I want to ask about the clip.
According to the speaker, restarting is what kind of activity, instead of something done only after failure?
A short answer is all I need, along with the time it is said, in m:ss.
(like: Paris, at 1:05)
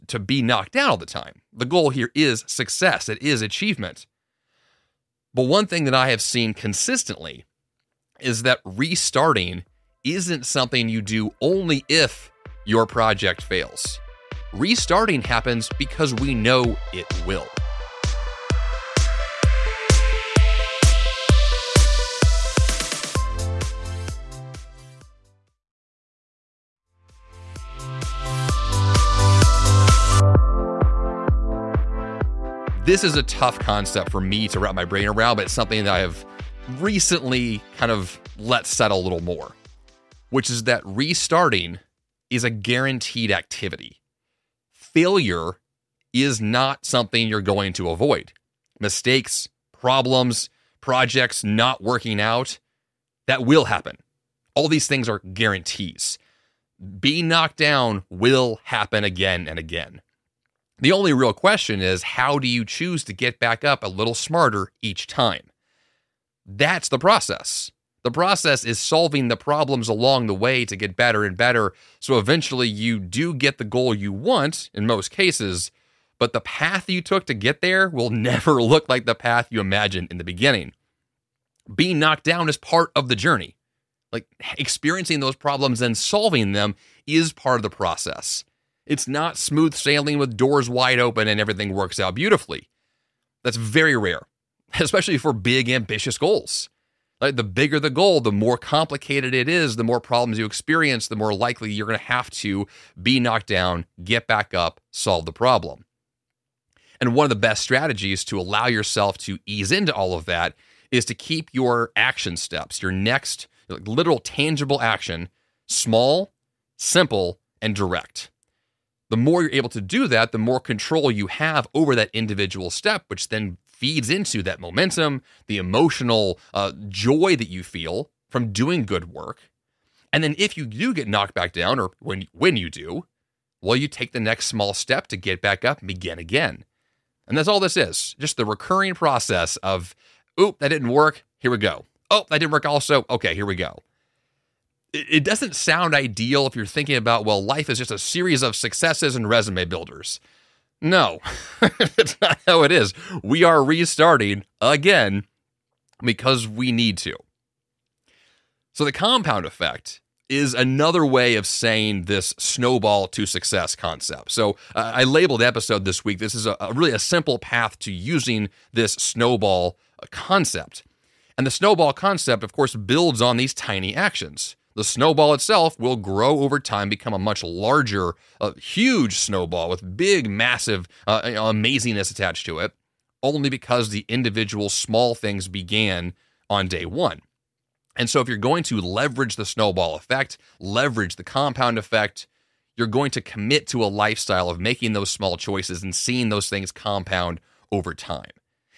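a guaranteed activity, at 0:42.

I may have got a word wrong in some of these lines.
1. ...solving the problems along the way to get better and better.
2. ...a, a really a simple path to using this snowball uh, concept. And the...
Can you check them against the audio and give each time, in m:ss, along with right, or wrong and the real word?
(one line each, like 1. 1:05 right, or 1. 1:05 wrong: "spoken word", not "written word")
1. 1:08 right
2. 2:46 right.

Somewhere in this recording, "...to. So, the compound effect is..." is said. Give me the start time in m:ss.
2:36.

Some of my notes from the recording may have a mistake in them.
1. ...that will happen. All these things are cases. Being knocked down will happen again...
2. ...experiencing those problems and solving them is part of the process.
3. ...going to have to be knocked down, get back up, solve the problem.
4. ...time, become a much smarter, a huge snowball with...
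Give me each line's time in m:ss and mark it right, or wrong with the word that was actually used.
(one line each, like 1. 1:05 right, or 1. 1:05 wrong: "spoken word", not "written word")
1. 0:53 wrong: "guarantees", not "cases"
2. 1:24 right
3. 1:41 right
4. 2:56 wrong: "larger", not "smarter".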